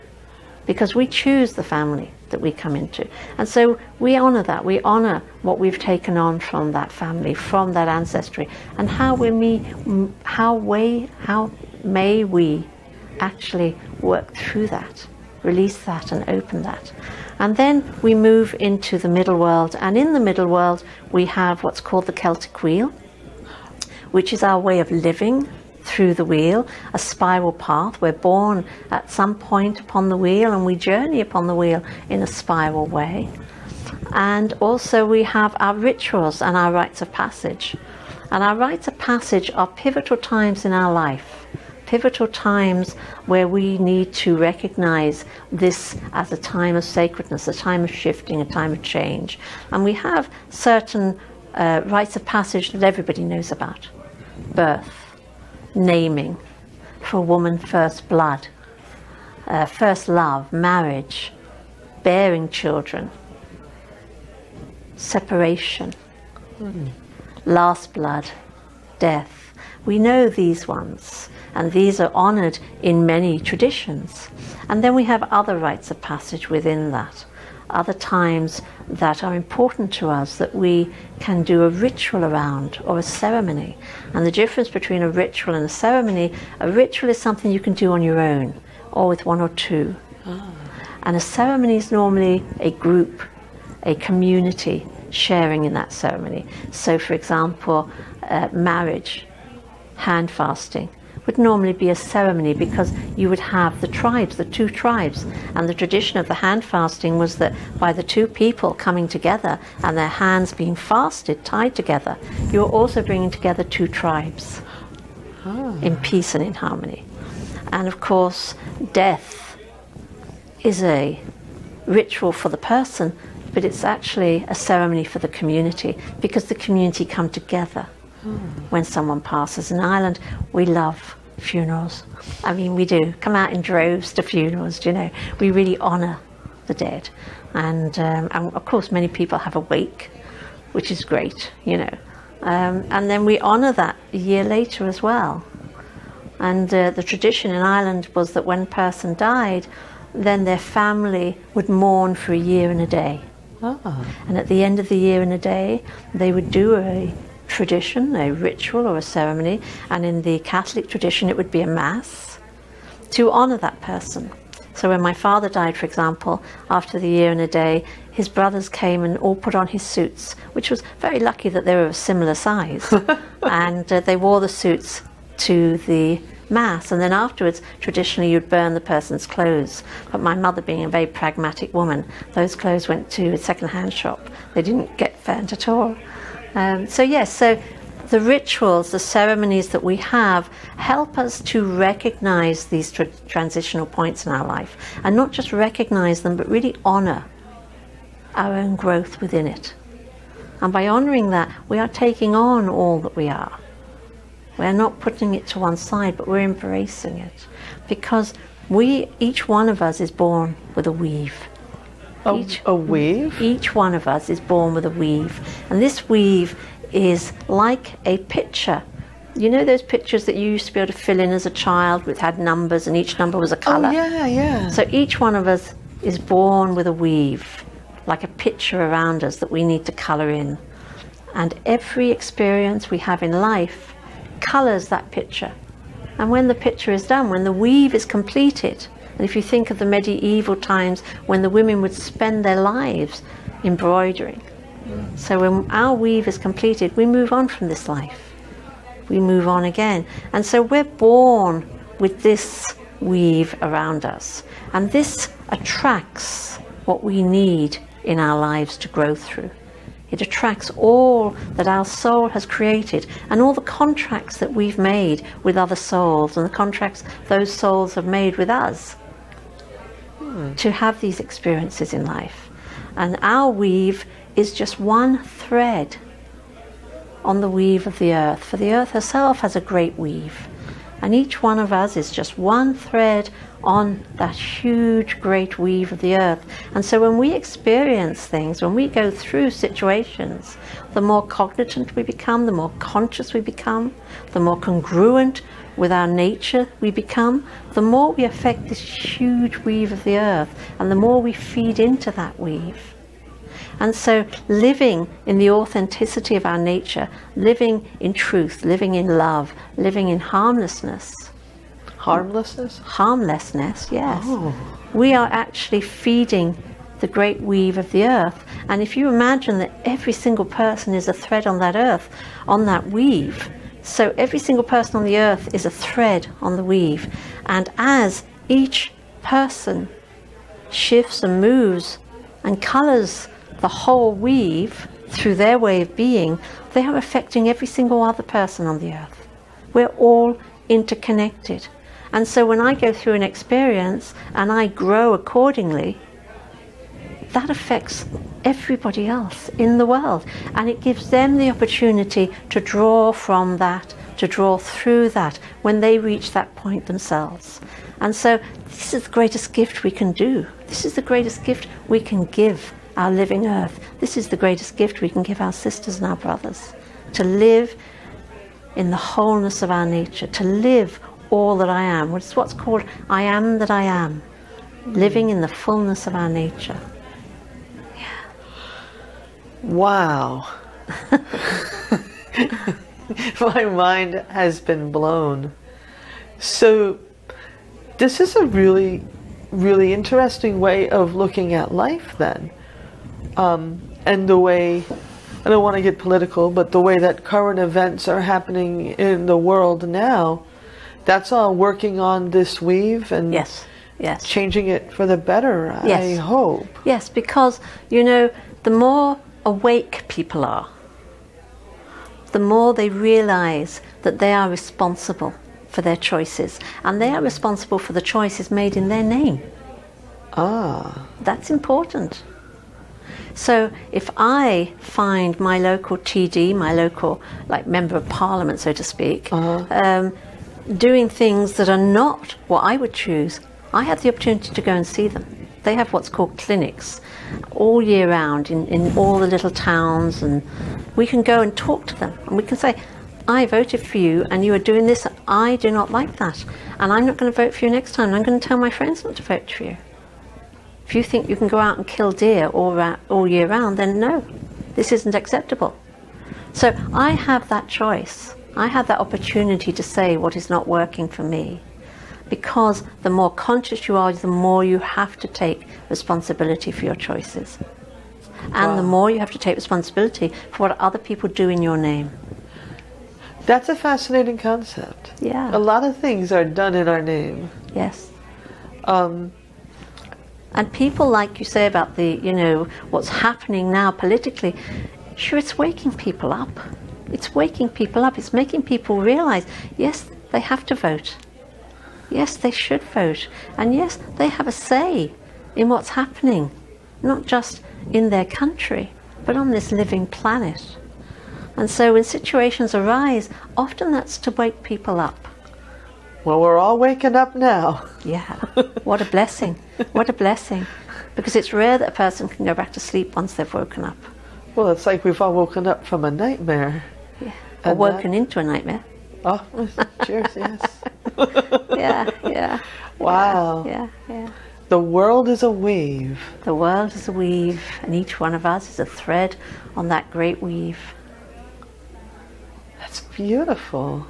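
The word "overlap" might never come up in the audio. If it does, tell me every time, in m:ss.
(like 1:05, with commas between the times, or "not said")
not said.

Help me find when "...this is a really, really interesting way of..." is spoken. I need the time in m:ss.
6:27.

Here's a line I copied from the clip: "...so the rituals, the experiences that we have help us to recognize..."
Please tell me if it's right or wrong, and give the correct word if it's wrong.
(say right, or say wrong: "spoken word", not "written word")
wrong: "ceremonies", not "experiences".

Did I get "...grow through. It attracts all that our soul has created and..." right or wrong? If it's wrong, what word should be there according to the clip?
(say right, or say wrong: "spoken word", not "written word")
right.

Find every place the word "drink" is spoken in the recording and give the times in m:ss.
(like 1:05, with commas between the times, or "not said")
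not said.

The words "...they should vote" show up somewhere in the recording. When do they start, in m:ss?
8:12.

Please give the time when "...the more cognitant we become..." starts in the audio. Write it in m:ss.
4:50.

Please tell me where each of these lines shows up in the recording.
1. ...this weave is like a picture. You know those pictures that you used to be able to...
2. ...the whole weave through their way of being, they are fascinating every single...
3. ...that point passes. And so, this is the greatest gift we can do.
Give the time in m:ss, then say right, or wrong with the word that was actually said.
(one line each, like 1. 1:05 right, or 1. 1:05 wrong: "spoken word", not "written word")
1. 3:35 right
2. 5:33 wrong: "affecting", not "fascinating"
3. 5:56 wrong: "themselves", not "passes".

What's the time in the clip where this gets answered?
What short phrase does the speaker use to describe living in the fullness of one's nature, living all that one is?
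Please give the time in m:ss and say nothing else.
6:13.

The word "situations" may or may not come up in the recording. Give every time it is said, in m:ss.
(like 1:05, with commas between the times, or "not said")
4:49, 8:22.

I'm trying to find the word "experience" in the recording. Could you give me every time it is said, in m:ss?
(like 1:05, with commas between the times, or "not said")
3:52, 4:31, 4:47, 5:43.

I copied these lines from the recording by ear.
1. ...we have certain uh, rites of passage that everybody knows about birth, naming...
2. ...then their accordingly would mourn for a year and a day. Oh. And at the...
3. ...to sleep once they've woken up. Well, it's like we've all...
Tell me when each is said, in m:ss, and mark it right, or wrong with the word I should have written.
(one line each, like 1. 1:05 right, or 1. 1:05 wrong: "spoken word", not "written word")
1. 0:49 right
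2. 2:30 wrong: "family", not "accordingly"
3. 8:32 right.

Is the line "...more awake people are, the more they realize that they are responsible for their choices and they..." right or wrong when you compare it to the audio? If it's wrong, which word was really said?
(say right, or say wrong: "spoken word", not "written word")
right.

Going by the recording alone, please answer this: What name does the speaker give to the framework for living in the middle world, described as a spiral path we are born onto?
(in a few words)
Celtic wheel.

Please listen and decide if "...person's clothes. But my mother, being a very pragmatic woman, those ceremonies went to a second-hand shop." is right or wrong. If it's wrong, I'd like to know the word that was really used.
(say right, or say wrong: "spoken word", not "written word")
wrong: "clothes", not "ceremonies".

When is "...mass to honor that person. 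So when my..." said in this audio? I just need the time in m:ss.
2:41.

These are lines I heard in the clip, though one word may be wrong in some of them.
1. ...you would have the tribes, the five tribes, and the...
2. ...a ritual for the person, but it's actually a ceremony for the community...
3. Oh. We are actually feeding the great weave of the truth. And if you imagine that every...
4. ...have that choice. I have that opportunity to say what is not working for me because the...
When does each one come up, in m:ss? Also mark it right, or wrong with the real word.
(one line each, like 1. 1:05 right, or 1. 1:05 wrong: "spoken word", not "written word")
1. 1:43 wrong: "two", not "five"
2. 2:00 right
3. 5:14 wrong: "earth", not "truth"
4. 7:37 right.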